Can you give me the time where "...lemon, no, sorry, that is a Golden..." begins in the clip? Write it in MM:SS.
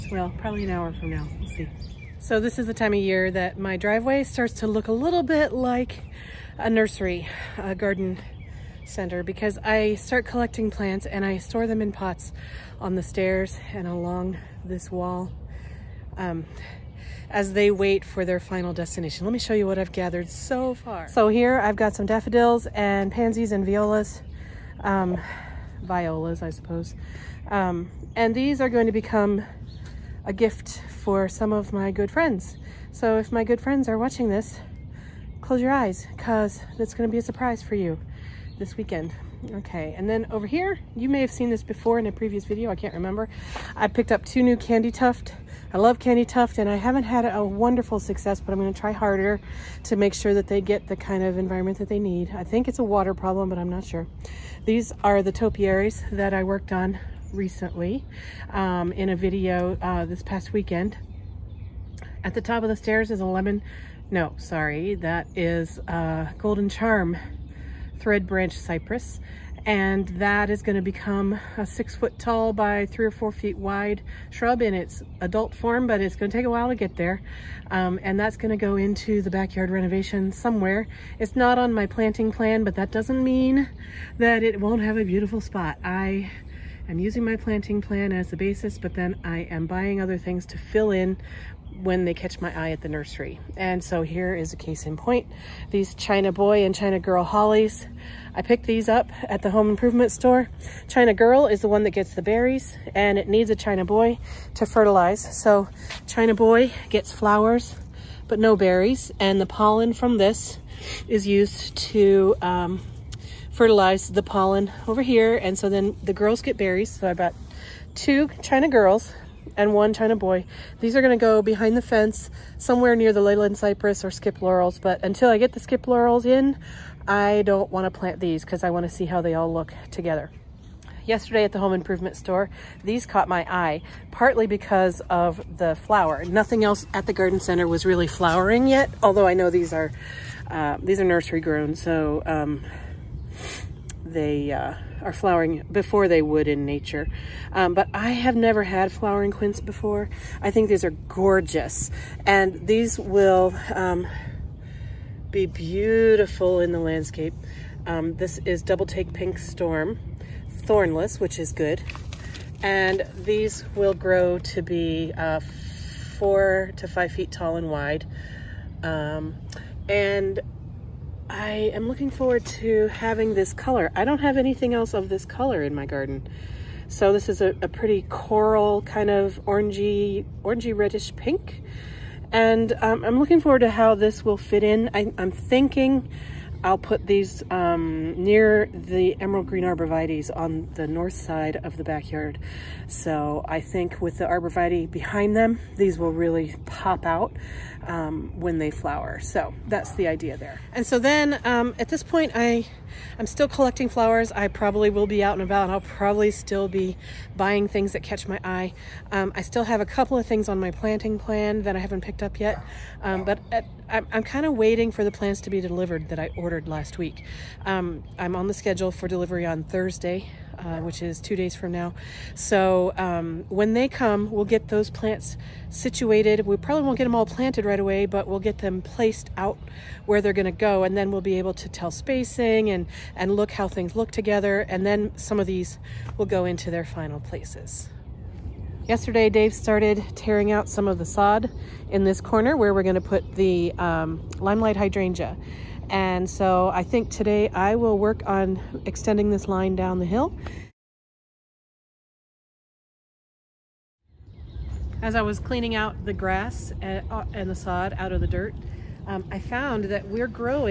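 01:03.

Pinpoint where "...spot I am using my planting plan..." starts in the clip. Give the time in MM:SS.
01:25.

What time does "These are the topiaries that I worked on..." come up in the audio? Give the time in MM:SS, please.
00:54.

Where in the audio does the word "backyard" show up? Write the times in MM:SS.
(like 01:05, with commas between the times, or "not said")
01:19, 03:11.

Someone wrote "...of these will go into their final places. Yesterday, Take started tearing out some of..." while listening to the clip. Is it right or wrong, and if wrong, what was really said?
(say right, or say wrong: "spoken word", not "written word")
wrong: "Dave", not "Take".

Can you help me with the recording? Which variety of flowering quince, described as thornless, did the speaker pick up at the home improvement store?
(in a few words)
Double Take Pink Storm.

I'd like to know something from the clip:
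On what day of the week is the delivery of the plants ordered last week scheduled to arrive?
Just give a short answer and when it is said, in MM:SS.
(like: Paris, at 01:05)
Thursday, at 03:39.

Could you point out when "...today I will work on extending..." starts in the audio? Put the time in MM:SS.
04:07.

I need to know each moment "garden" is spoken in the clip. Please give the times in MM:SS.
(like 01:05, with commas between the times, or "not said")
00:07, 02:17, 02:55.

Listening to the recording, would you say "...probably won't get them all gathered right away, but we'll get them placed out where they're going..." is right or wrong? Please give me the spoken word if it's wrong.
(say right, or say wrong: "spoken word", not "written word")
wrong: "planted", not "gathered".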